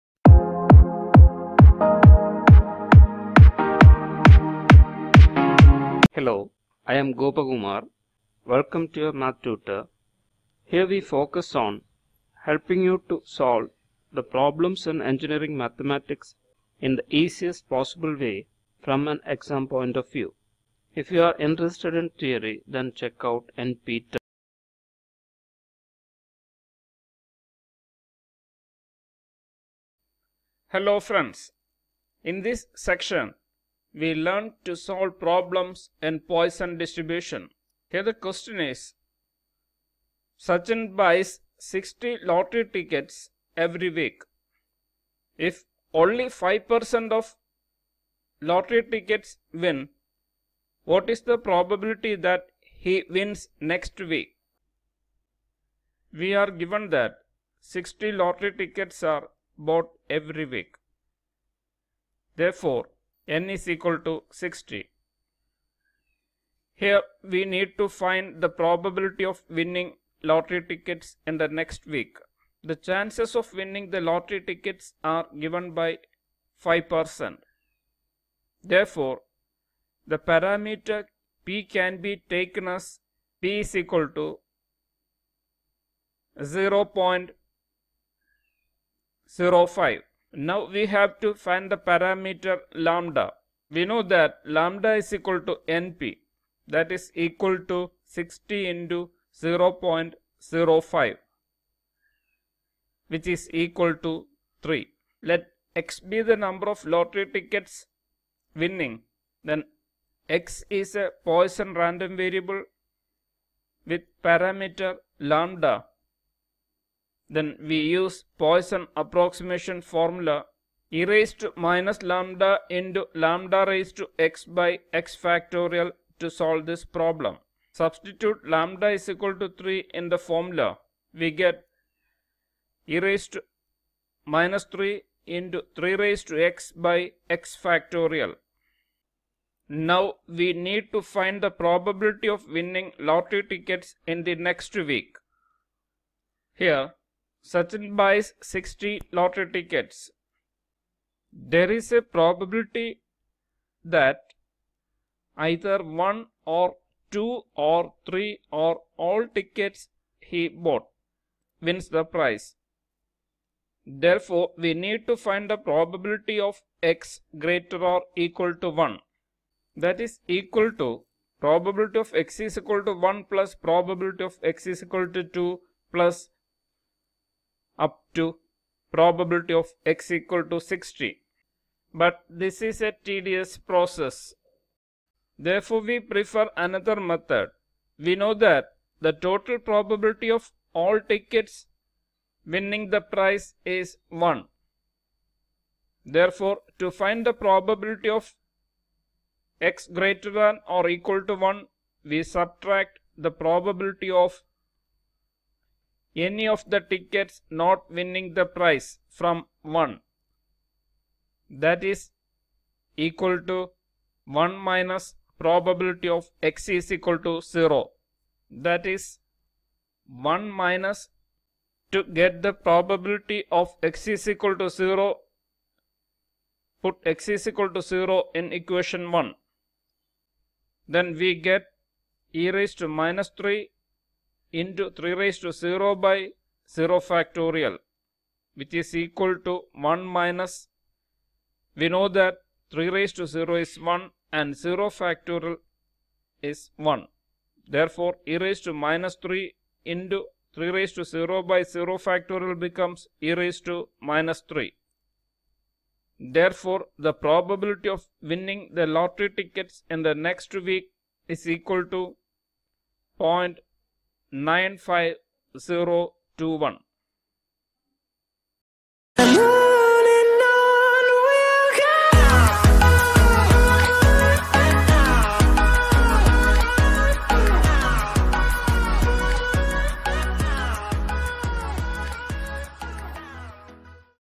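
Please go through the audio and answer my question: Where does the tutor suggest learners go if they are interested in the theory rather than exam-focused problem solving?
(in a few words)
NPTEL.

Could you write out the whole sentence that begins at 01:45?
Let x be the number of lottery tickets winning.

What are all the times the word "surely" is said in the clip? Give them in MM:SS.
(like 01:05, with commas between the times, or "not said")
not said.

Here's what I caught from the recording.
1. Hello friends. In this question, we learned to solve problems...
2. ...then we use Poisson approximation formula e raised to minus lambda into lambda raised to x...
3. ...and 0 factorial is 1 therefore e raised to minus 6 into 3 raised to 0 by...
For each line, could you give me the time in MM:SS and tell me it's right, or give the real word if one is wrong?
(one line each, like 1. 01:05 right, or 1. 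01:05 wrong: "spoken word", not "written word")
1. 00:30 wrong: "section", not "question"
2. 01:57 right
3. 04:04 wrong: "3", not "6".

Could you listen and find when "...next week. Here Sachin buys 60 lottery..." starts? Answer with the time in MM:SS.
02:24.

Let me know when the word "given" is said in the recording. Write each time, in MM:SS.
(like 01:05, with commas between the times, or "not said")
00:56, 01:15.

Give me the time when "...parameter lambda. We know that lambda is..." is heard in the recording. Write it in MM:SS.
01:31.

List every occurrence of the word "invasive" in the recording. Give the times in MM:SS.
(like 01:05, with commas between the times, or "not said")
not said.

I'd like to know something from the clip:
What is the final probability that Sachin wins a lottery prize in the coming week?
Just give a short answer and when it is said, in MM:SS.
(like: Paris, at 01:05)
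0.95021, at 04:23.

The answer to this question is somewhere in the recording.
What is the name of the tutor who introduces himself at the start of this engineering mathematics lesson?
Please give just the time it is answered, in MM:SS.
00:07.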